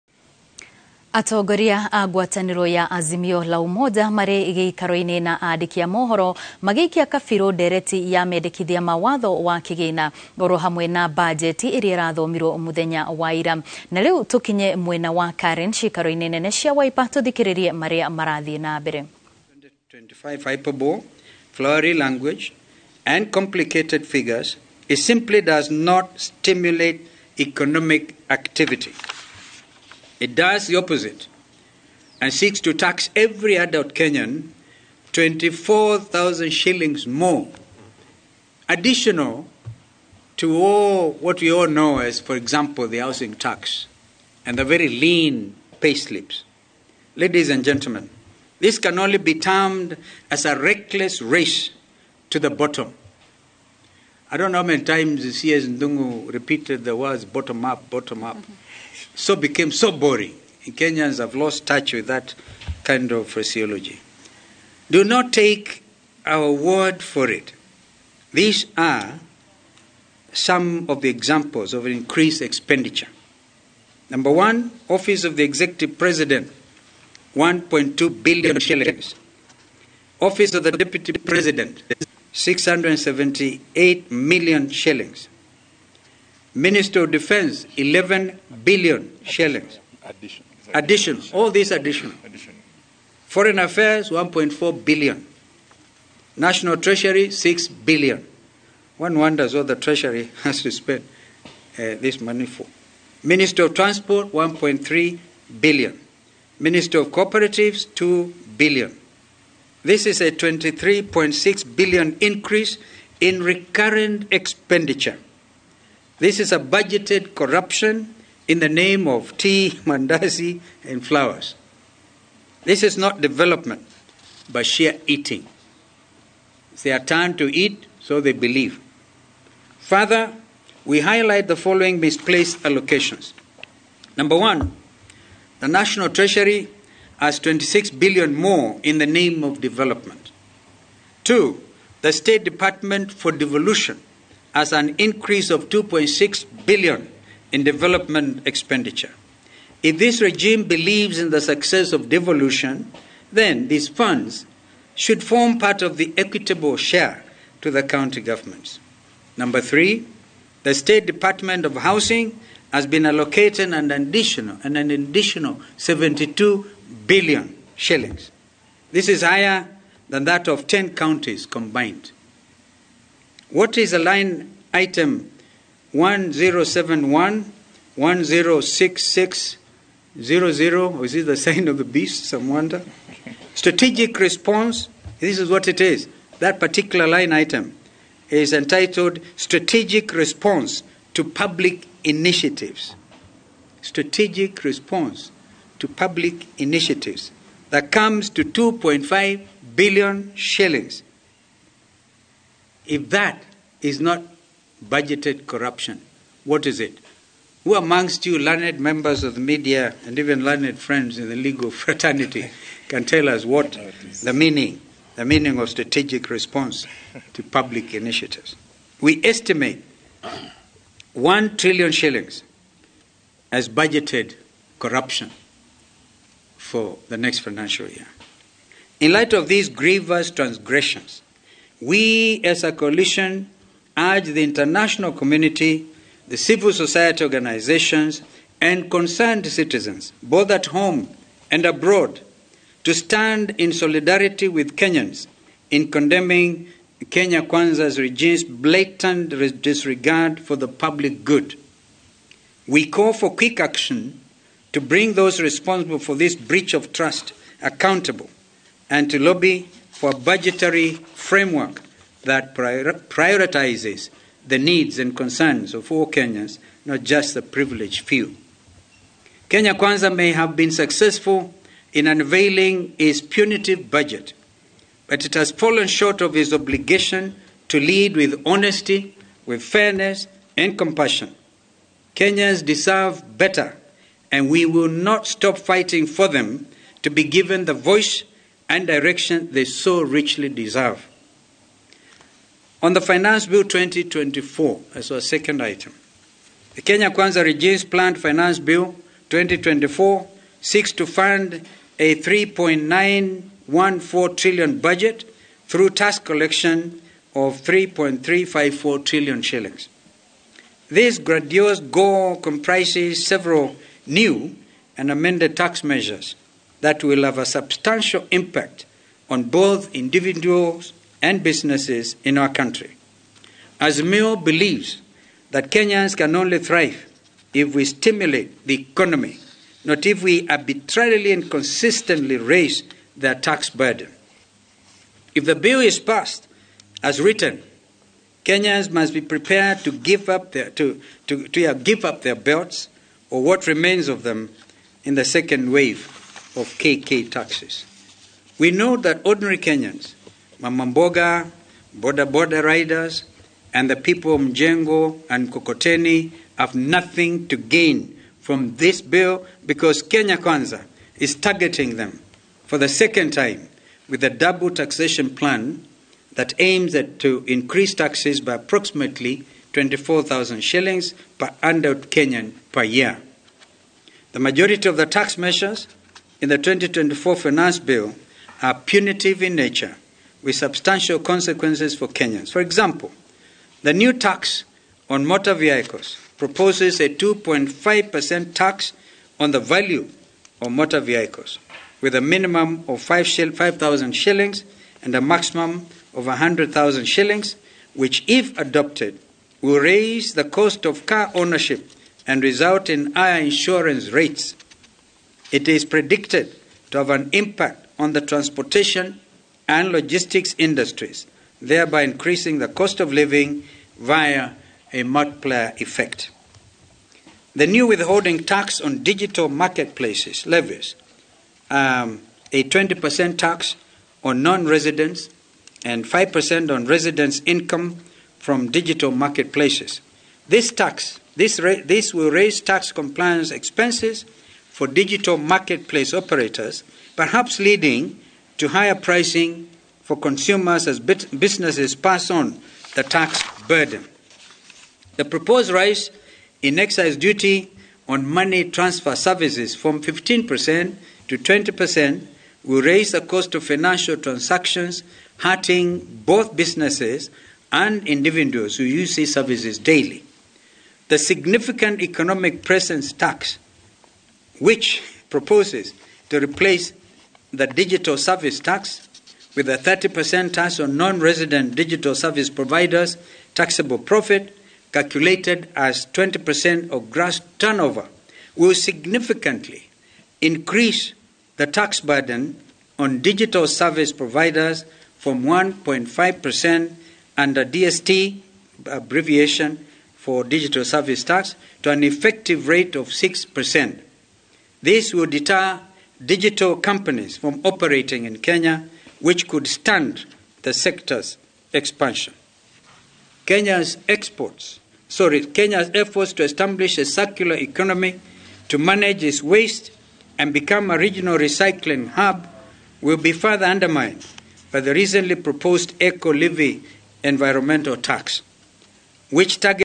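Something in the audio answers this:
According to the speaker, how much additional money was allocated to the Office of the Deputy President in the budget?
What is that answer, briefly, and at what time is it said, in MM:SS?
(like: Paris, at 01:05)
678 million shillings, at 01:22.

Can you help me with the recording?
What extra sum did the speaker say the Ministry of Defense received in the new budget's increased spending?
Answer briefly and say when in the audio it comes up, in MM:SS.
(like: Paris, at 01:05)
11 billion shillings, at 01:27.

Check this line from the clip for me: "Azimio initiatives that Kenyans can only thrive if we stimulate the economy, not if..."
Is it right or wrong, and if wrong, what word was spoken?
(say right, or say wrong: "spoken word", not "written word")
wrong: "believes", not "initiatives".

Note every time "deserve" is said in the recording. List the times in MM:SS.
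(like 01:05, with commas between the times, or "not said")
04:42, 04:50.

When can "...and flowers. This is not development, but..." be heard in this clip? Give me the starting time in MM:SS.
02:00.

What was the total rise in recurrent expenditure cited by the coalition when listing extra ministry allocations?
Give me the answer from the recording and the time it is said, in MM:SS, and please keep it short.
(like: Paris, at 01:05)
23.6 billion, at 01:50.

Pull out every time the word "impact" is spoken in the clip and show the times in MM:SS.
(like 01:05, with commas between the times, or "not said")
05:18, 06:47.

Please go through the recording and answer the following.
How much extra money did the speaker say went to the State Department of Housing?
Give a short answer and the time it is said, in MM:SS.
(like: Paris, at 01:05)
72 billion shillings, at 02:45.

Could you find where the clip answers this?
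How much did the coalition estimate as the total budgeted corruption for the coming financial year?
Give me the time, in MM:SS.
03:41.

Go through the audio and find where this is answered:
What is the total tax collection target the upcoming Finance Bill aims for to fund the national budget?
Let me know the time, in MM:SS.
05:07.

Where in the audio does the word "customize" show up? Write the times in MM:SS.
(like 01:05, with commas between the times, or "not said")
not said.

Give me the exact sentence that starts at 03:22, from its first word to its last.
If that is not budgeted corruption, what is it?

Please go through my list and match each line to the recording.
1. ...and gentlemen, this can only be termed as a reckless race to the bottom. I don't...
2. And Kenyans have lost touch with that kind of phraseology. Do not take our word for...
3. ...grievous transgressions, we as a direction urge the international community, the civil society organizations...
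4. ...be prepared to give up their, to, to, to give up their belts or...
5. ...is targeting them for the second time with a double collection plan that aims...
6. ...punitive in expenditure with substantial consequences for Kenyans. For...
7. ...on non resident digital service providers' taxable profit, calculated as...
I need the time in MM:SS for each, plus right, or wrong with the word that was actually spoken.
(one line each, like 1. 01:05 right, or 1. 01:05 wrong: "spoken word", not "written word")
1. 00:47 right
2. 01:00 right
3. 03:49 wrong: "coalition", not "direction"
4. 05:39 right
5. 06:01 wrong: "taxation", not "collection"
6. 06:18 wrong: "nature", not "expenditure"
7. 07:50 right.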